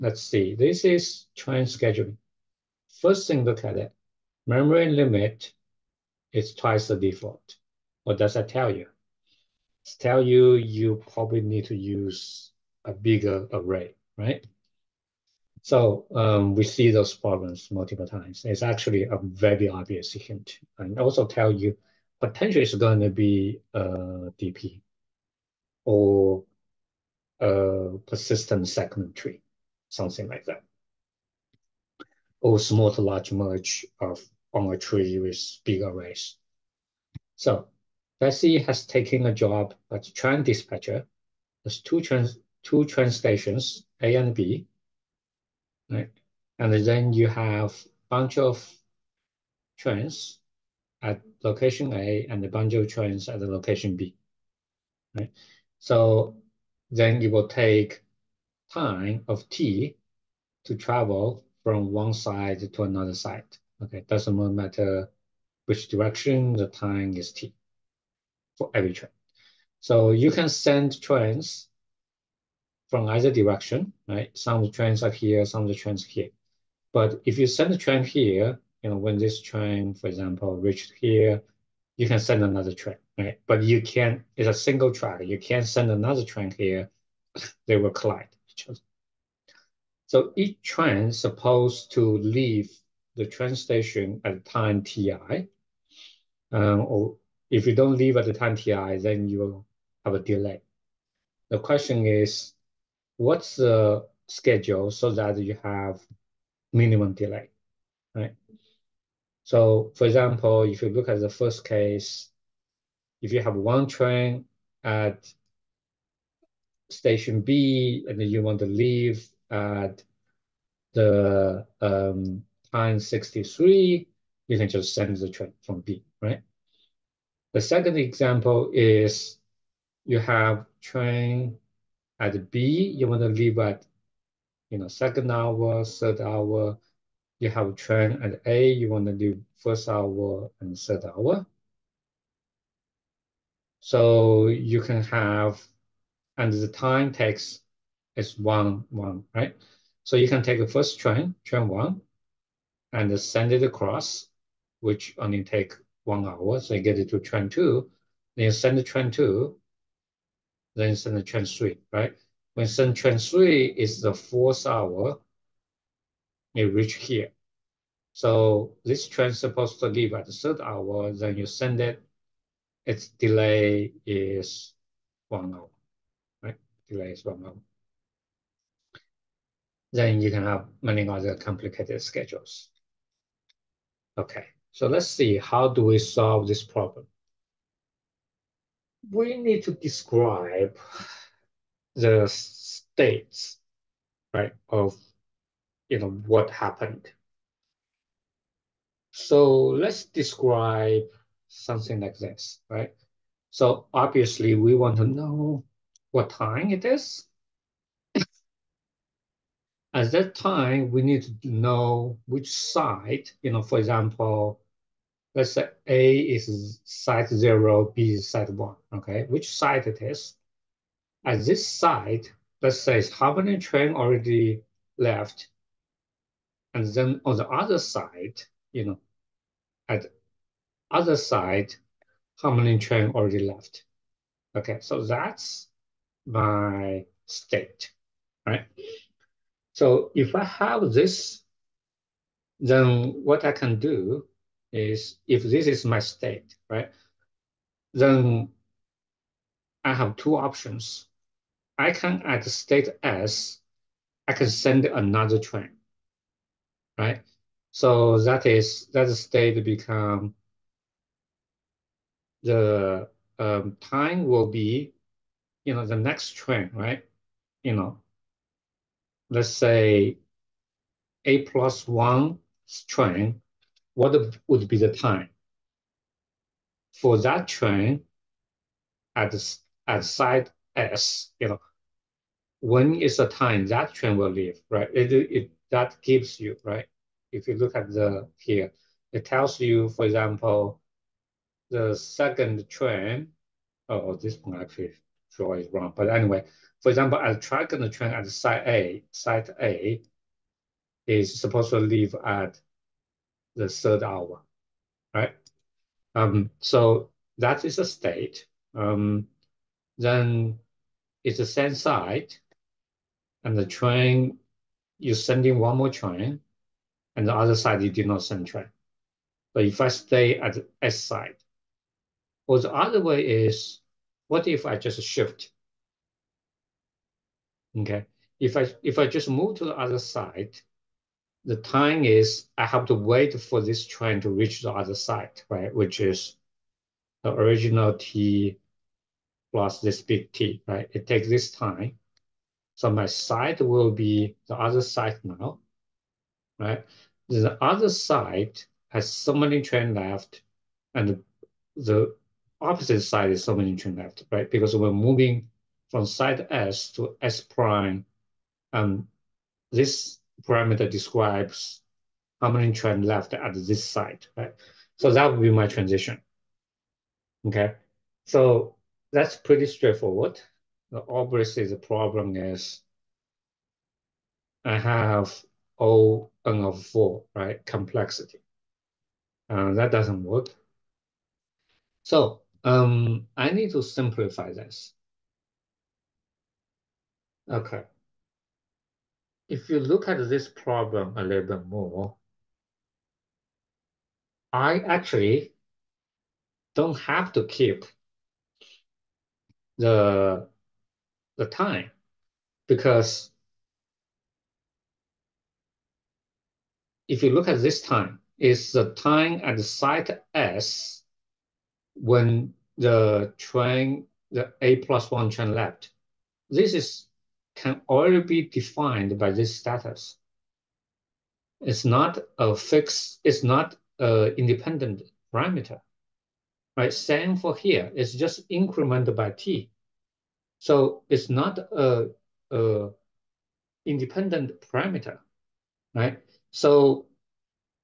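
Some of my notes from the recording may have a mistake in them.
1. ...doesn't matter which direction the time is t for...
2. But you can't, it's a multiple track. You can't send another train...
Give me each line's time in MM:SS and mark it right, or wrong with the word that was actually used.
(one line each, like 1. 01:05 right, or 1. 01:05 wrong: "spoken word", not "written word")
1. 01:04 right
2. 01:23 wrong: "single", not "multiple".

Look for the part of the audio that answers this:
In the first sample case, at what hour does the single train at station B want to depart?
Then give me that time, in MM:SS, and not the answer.
02:03.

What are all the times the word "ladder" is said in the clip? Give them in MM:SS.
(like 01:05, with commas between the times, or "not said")
not said.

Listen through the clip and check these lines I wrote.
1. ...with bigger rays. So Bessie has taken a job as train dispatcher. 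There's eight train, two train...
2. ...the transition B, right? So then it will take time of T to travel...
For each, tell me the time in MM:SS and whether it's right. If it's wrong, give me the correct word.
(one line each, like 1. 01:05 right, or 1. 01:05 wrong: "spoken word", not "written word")
1. 00:35 wrong: "two", not "eight"
2. 00:53 wrong: "location", not "transition".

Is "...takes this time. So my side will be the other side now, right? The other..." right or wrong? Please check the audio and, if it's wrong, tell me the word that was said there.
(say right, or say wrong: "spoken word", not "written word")
right.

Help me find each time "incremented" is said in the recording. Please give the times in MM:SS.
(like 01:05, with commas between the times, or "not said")
07:08.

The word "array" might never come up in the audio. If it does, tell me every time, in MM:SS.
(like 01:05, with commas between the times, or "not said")
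00:13.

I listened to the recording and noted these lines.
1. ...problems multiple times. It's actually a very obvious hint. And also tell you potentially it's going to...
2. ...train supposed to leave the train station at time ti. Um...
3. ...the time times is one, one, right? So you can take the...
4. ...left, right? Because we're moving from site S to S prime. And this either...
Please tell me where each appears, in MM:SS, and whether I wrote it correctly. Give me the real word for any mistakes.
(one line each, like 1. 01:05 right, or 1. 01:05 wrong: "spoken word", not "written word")
1. 00:17 right
2. 01:30 right
3. 02:26 wrong: "takes", not "times"
4. 05:53 wrong: "parameter", not "either".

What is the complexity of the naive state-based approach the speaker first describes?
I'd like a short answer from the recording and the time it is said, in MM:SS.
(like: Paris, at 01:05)
O(n^4), at 06:15.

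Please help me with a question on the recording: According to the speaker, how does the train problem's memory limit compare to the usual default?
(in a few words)
Twice the default.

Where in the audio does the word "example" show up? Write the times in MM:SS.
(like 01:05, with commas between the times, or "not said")
01:20, 01:50, 02:07, 03:33, 04:50, 04:56.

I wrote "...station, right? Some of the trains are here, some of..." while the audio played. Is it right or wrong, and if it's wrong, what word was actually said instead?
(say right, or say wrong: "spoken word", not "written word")
wrong: "direction", not "station".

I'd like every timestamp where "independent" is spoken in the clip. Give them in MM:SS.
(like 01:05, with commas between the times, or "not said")
07:04, 07:13.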